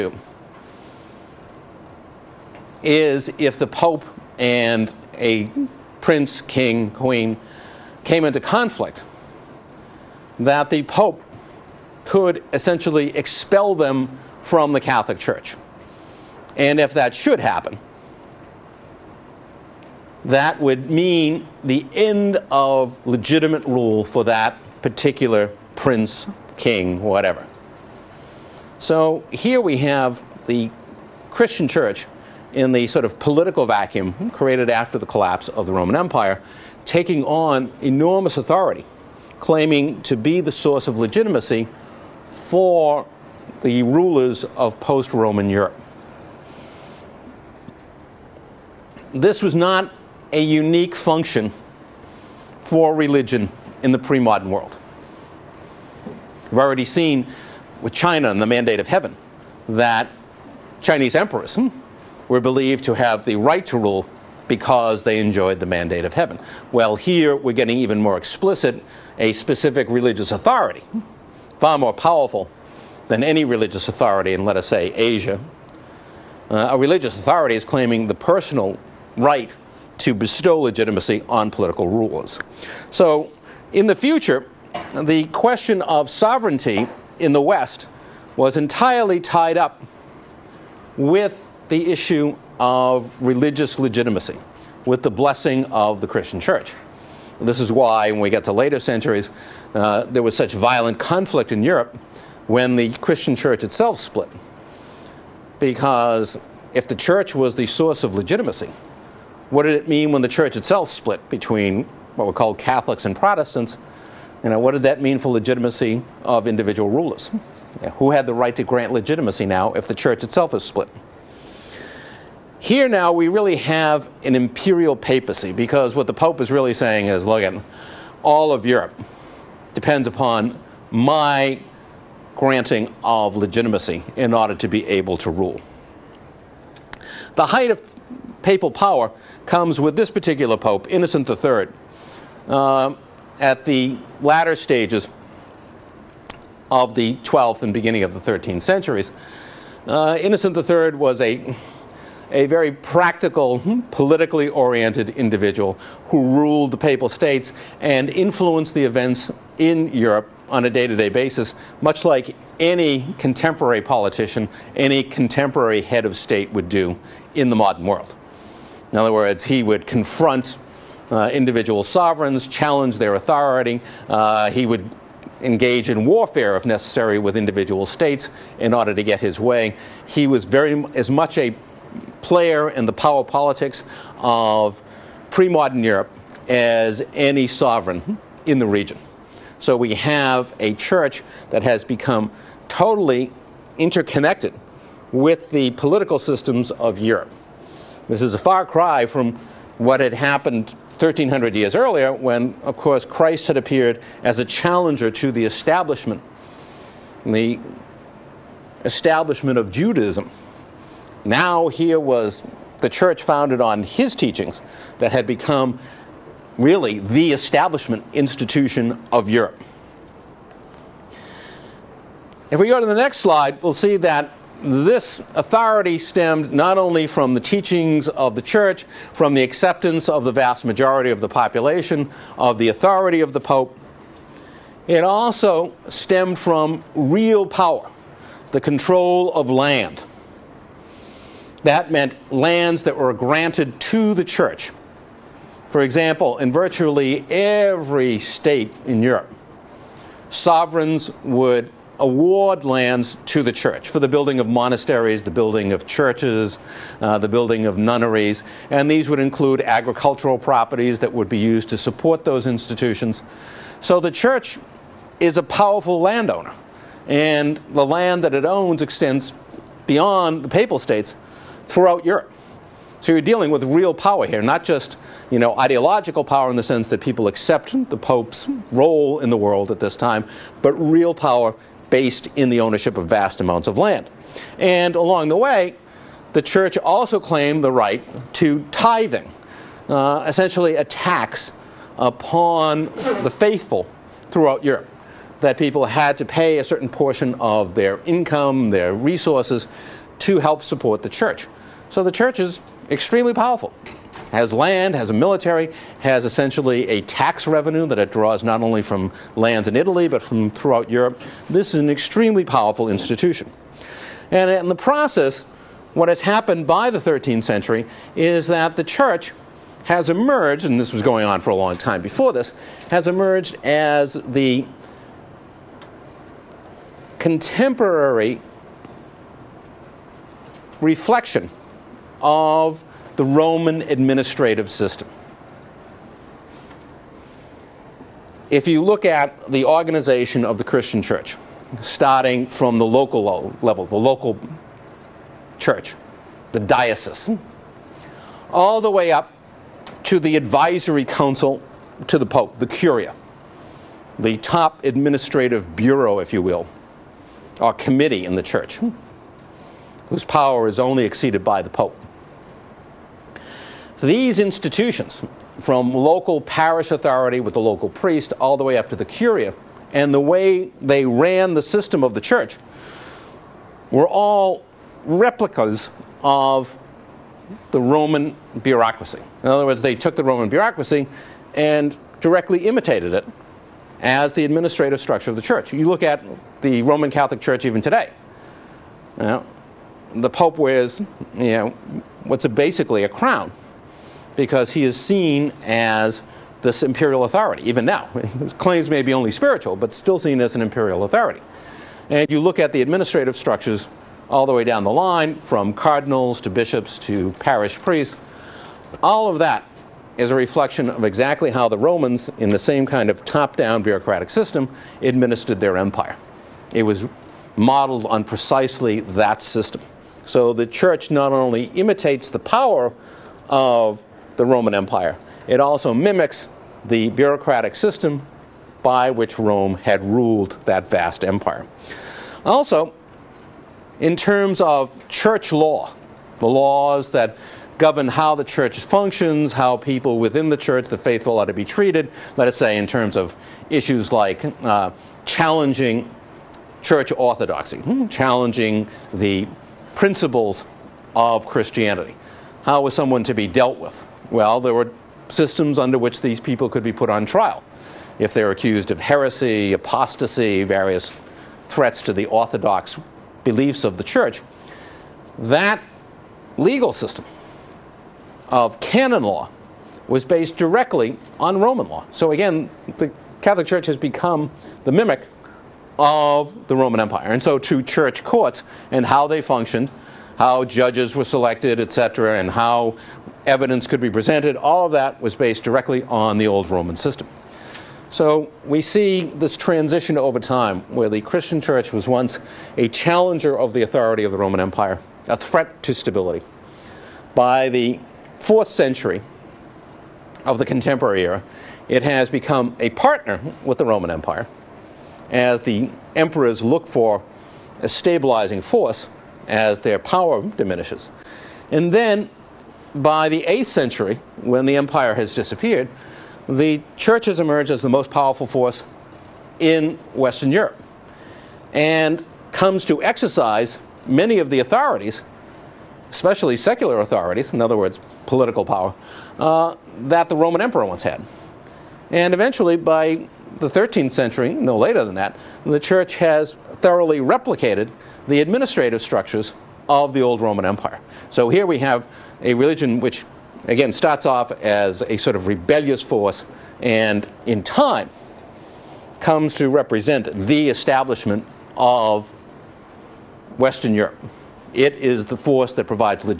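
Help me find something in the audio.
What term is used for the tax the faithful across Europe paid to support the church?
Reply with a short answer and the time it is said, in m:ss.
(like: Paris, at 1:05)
Tithing, at 4:48.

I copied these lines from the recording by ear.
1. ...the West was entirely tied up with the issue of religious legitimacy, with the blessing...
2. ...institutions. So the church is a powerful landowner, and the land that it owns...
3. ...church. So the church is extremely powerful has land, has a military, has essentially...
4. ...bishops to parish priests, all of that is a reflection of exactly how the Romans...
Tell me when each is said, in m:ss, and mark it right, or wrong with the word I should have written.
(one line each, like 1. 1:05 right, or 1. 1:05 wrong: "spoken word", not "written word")
1. 1:27 right
2. 4:22 right
3. 5:01 right
4. 6:46 right.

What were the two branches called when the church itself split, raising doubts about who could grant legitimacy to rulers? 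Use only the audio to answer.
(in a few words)
Catholics and Protestants.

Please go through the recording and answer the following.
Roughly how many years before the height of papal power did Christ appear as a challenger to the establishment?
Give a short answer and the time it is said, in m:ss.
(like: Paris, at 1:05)
1300, at 3:20.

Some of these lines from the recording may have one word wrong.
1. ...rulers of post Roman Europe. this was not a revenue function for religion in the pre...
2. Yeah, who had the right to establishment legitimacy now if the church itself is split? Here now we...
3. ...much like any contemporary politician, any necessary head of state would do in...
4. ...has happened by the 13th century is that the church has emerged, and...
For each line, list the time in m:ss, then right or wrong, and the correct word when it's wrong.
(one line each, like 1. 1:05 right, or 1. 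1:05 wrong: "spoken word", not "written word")
1. 0:43 wrong: "unique", not "revenue"
2. 1:57 wrong: "grant", not "establishment"
3. 2:41 wrong: "contemporary", not "necessary"
4. 5:16 right.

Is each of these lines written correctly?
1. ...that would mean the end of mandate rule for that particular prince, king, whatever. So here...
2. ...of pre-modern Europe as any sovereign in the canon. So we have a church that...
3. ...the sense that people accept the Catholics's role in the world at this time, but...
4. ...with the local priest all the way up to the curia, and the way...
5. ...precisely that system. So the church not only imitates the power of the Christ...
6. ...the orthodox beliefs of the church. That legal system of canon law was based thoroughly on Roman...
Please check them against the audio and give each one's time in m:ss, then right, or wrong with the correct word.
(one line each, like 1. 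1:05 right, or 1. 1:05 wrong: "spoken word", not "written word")
1. 0:20 wrong: "legitimate", not "mandate"
2. 3:04 wrong: "region", not "canon"
3. 4:36 wrong: "Pope", not "Catholics"
4. 6:07 right
5. 6:58 wrong: "Roman", not "Christ"
6. 7:42 wrong: "directly", not "thoroughly".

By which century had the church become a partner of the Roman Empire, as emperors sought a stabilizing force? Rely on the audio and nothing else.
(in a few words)
4th century.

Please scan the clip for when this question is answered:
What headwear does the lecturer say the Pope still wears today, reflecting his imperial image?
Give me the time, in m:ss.
6:33.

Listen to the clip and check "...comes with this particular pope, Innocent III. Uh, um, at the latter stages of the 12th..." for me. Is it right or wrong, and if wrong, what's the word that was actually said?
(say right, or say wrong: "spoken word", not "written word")
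right.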